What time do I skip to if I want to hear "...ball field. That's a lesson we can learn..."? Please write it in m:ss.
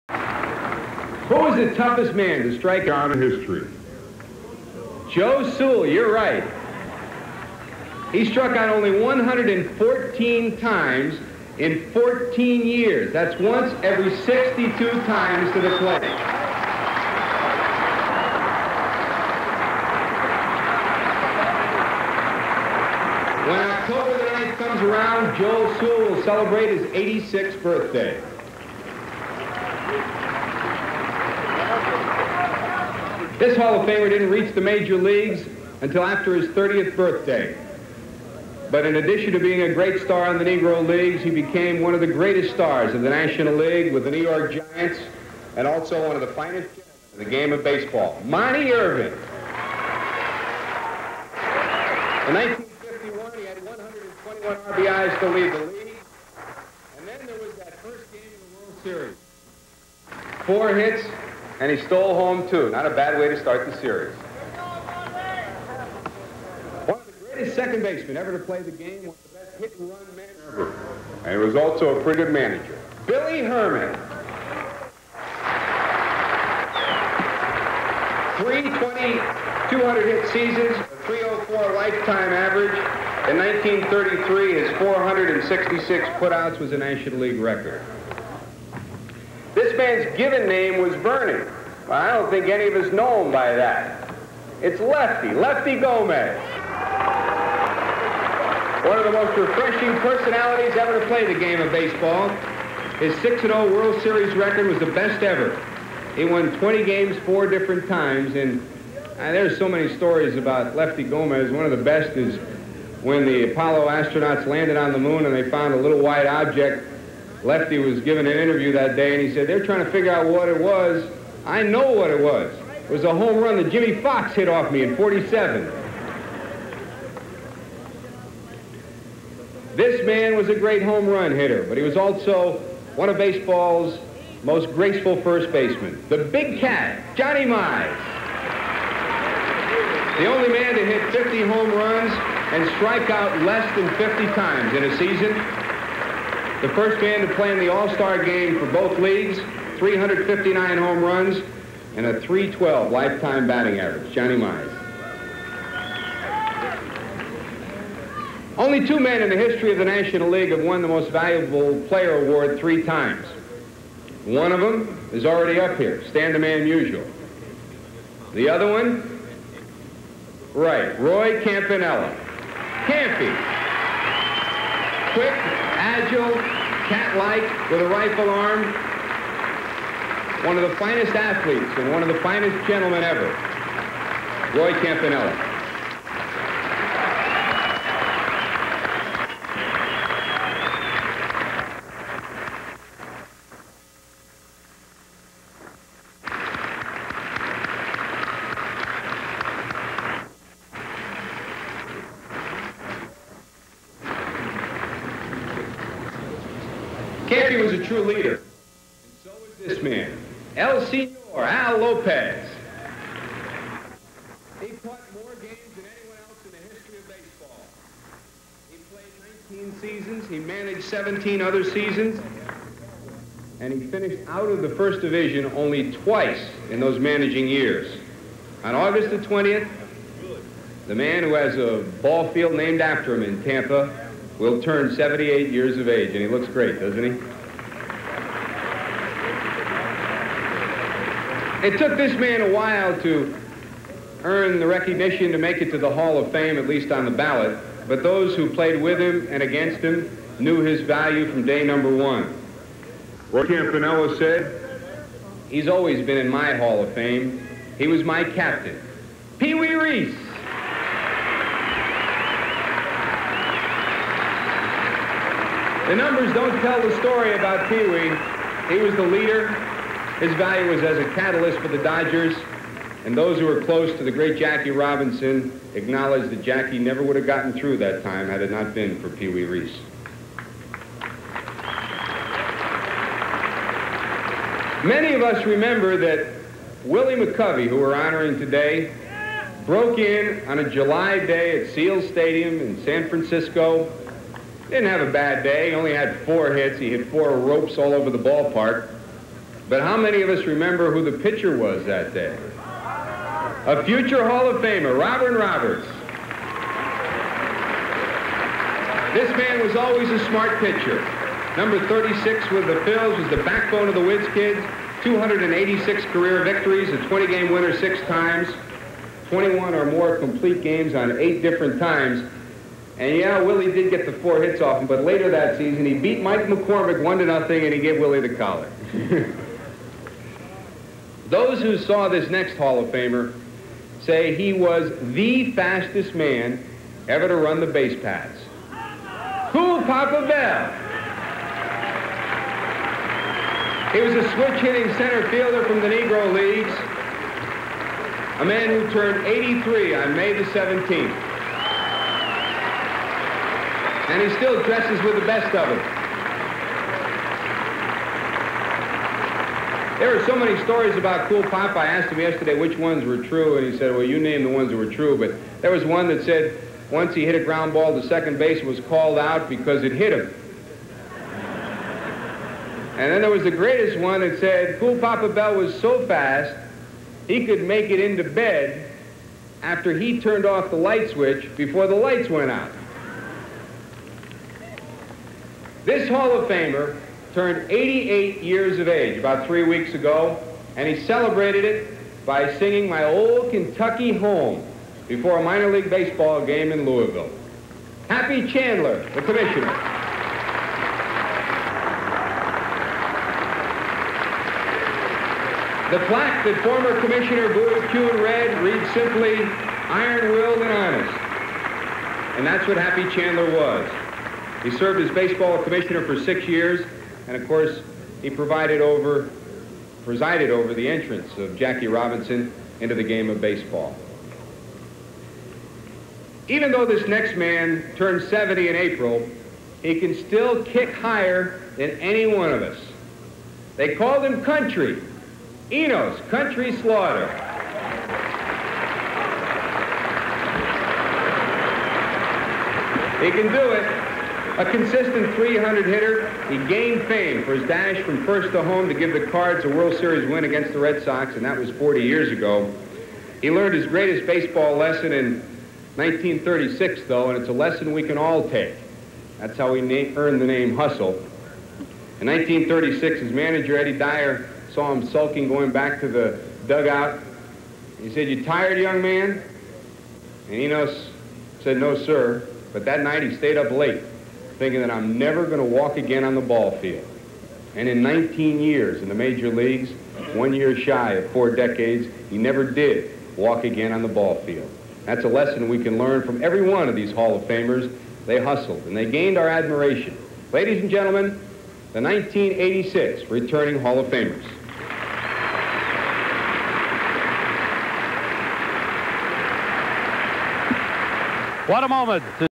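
8:04.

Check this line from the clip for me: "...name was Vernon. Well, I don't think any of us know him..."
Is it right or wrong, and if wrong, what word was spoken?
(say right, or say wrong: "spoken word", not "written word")
right.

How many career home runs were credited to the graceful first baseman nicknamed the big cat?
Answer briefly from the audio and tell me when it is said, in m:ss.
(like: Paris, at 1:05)
359, at 2:29.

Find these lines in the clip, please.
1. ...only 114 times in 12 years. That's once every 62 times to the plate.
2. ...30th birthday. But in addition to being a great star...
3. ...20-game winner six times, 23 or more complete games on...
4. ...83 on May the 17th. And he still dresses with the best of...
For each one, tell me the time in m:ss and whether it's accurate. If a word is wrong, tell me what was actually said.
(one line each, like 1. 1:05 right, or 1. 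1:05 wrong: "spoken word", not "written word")
1. 0:08 wrong: "14", not "12"
2. 0:36 right
3. 5:17 wrong: "21", not "23"
4. 5:49 right.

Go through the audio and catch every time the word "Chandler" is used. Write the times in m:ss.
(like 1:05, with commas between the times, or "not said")
6:38, 6:53.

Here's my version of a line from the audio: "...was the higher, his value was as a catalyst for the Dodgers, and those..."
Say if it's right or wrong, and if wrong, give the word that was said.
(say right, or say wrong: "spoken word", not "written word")
wrong: "leader", not "higher".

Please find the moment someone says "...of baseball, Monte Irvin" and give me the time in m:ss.
0:47.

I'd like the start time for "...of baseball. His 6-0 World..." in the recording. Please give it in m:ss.
1:41.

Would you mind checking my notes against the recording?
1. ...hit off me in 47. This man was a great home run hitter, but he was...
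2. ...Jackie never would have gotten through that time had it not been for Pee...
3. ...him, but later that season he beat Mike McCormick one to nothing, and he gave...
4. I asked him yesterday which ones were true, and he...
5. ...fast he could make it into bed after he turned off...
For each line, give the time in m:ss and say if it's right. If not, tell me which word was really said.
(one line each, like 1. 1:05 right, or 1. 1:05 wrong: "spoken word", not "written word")
1. 2:04 right
2. 4:36 right
3. 5:24 right
4. 6:01 right
5. 6:16 right.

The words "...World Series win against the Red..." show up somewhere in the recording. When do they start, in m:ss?
7:29.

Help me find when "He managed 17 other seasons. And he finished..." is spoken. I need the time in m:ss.
3:40.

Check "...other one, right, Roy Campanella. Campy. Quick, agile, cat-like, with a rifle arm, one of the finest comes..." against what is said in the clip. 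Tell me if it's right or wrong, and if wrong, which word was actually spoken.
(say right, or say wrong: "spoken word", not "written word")
wrong: "athletes", not "comes".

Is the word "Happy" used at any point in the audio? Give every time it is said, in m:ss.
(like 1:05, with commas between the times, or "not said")
6:38, 6:52.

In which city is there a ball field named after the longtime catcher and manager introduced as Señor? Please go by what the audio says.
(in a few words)
Tampa.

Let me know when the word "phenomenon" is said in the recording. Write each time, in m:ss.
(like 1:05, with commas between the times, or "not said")
not said.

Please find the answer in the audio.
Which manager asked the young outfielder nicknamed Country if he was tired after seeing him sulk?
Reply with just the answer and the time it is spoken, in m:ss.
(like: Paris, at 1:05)
Eddie Dyer, at 7:43.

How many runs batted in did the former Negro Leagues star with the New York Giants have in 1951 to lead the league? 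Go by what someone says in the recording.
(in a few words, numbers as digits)
121.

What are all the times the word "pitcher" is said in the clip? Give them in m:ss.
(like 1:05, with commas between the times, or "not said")
5:01, 5:10.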